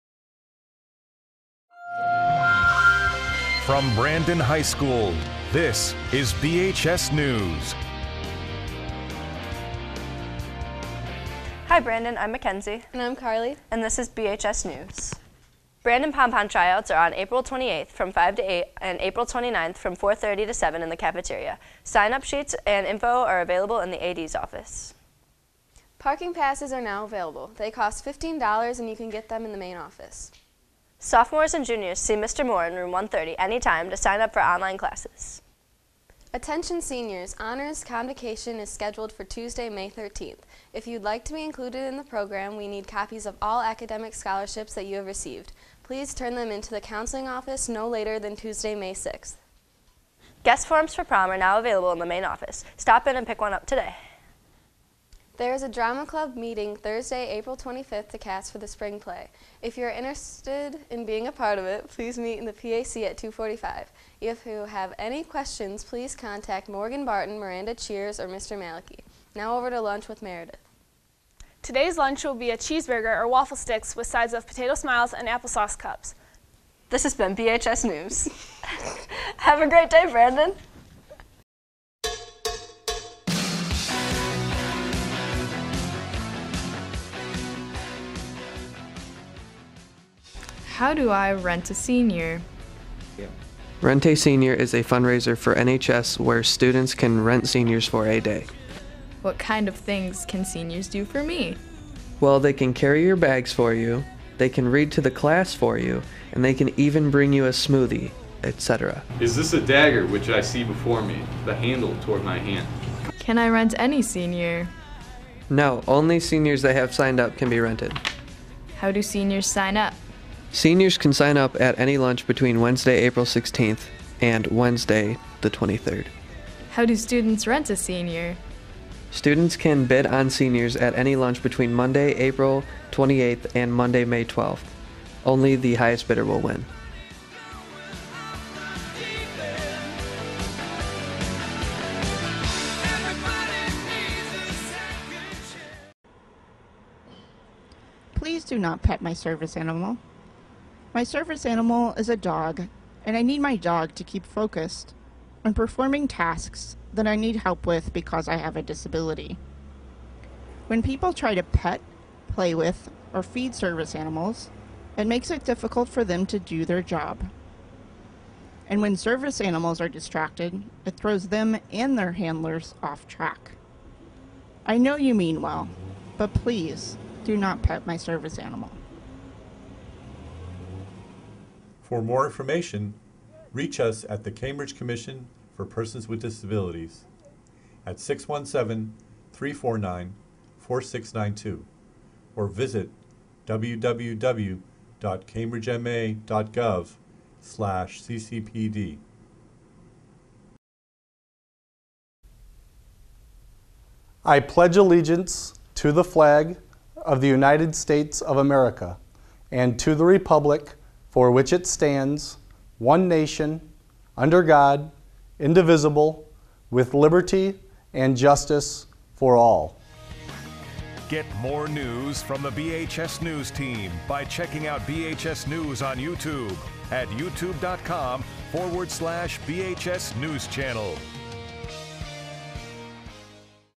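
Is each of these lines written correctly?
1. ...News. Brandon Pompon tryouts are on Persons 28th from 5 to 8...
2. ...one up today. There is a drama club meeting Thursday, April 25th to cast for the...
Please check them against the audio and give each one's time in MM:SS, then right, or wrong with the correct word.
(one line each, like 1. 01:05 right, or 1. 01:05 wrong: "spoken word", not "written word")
1. 00:14 wrong: "April", not "Persons"
2. 00:53 right.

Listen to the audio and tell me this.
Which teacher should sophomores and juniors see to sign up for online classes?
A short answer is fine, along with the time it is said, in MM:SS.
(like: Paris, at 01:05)
Mr. Moore, at 00:32.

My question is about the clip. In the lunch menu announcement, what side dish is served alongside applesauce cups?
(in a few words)
potato smiles.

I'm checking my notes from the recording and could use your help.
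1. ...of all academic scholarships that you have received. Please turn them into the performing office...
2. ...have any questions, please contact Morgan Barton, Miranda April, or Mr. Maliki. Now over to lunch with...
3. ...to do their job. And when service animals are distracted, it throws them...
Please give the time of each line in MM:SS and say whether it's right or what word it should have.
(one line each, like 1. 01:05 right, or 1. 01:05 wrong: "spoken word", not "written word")
1. 00:43 wrong: "counseling", not "performing"
2. 01:04 wrong: "Cheers", not "April"
3. 02:46 right.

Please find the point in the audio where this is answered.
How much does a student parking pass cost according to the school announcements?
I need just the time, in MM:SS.
00:28.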